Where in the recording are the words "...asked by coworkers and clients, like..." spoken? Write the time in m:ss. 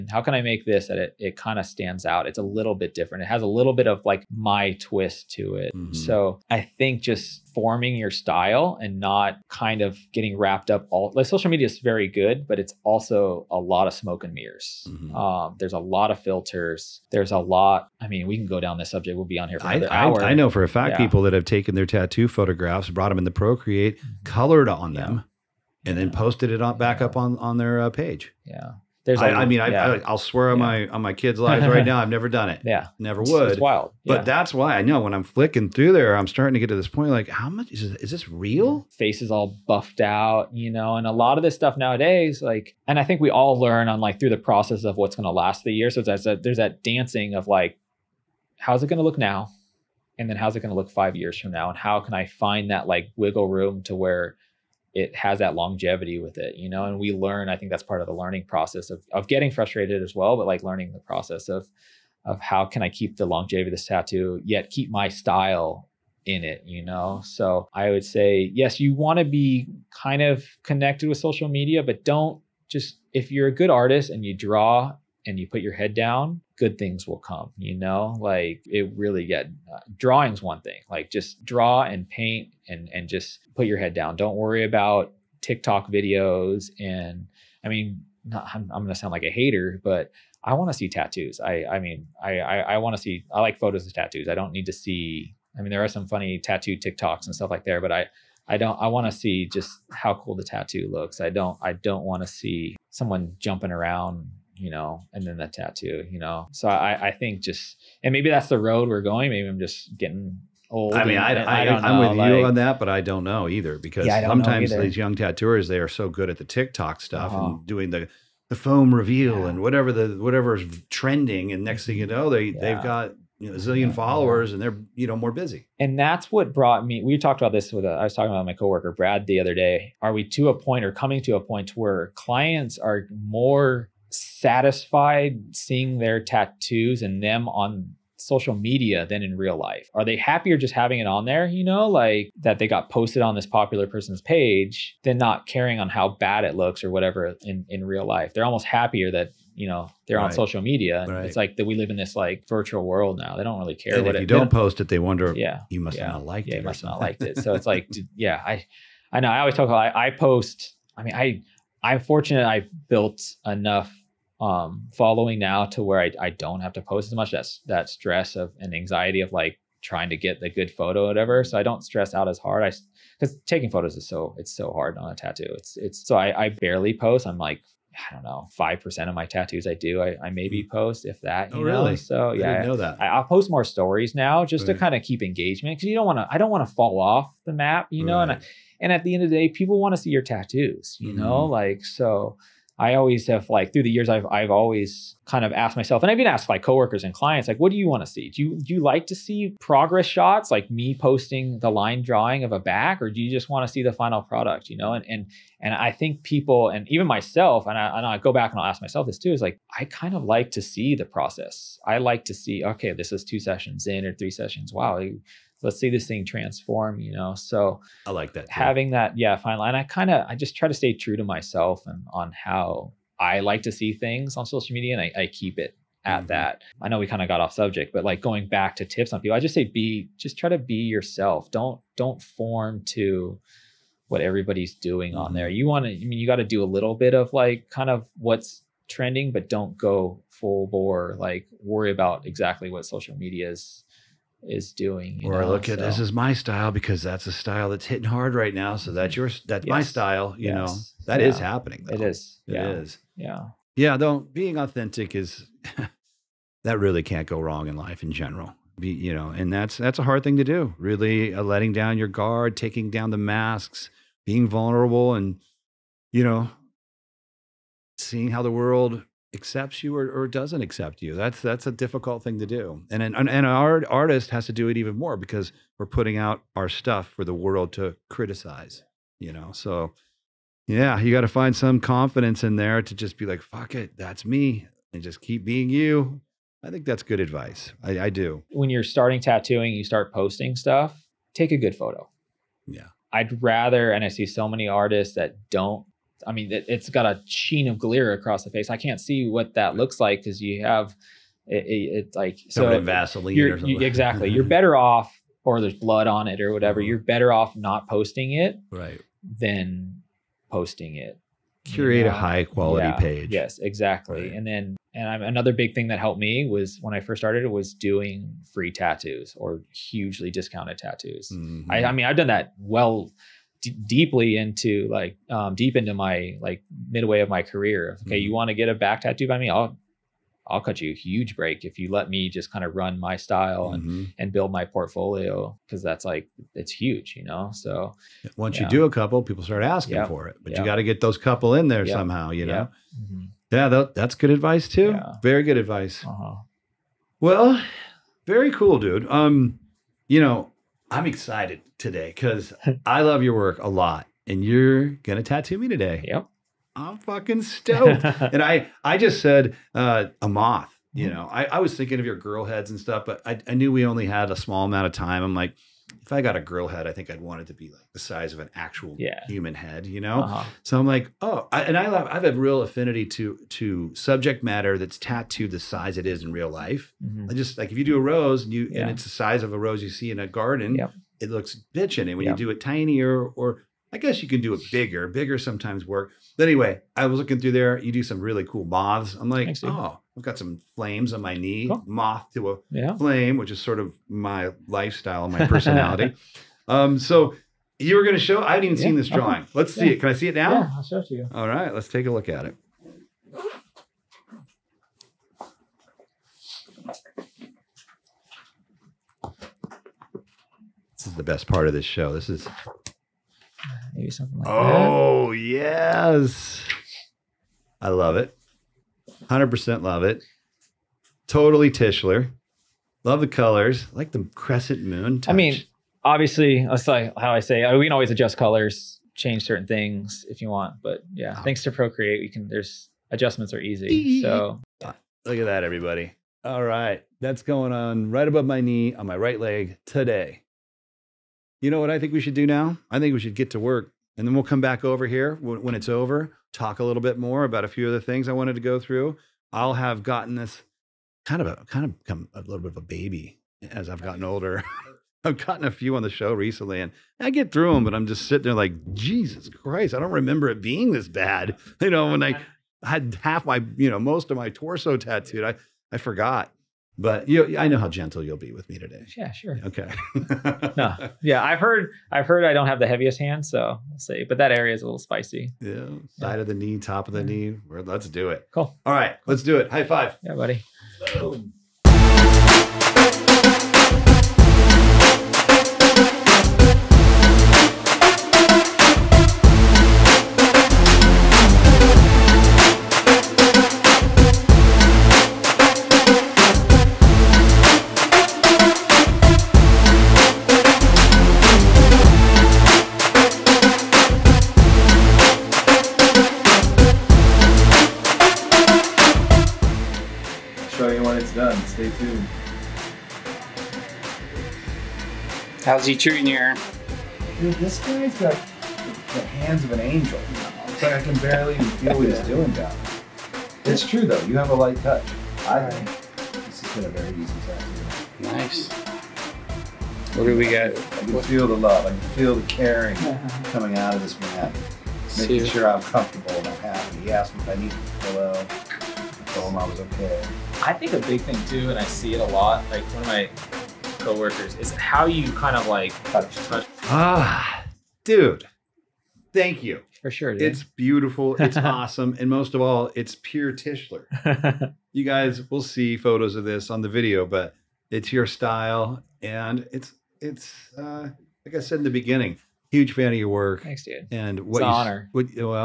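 3:16.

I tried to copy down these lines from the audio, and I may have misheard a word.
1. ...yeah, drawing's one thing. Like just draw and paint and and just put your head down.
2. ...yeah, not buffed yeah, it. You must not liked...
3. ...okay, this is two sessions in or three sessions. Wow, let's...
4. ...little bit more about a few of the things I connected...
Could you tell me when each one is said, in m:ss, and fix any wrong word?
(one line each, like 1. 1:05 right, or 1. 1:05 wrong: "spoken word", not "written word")
1. 1:19 right
2. 2:35 wrong: "liked", not "buffed"
3. 3:32 right
4. 7:26 wrong: "wanted", not "connected".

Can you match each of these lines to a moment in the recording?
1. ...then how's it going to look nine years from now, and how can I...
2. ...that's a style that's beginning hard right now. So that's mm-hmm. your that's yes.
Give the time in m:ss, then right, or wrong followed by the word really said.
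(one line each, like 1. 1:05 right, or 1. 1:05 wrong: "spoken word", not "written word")
1. 0:50 wrong: "five", not "nine"
2. 4:07 wrong: "hitting", not "beginning".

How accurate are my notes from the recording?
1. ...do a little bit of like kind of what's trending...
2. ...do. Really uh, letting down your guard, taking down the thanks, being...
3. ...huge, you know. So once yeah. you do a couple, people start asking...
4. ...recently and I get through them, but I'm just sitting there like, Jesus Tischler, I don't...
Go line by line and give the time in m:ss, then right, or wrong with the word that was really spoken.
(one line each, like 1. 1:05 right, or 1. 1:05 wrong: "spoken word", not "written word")
1. 3:56 right
2. 4:20 wrong: "masks", not "thanks"
3. 5:36 right
4. 7:36 wrong: "Christ", not "Tischler".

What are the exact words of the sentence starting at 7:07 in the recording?
We can always adjust colors, change certain things if you want.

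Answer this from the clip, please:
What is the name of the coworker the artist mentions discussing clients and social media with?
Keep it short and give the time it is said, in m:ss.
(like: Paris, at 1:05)
Brad, at 2:08.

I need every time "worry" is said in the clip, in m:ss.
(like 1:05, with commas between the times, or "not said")
1:24, 4:01.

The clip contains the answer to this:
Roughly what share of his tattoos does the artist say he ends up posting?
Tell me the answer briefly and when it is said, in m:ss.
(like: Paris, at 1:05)
5 percent, at 2:58.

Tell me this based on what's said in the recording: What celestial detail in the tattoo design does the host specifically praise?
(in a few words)
crescent moon.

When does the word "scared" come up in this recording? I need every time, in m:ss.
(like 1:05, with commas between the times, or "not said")
not said.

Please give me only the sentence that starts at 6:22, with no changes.
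you do it tinier or I guess you can do it bigger.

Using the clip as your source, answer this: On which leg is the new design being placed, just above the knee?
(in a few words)
right leg.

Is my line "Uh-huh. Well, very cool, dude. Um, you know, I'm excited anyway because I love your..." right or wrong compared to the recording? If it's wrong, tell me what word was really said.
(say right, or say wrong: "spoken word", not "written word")
wrong: "today", not "anyway".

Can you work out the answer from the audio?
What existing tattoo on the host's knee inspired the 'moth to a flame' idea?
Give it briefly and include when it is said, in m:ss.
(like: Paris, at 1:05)
flames, at 6:30.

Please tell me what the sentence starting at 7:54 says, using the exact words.
But that area is a little spicy.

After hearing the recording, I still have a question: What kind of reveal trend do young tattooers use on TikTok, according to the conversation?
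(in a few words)
foam reveal.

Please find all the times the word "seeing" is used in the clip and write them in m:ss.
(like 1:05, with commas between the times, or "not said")
2:15, 4:27.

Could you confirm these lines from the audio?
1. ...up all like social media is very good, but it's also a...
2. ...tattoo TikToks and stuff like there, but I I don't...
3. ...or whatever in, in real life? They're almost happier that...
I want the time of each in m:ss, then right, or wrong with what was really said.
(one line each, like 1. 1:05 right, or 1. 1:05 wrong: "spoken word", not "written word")
1. 0:10 right
2. 1:36 right
3. 2:26 right.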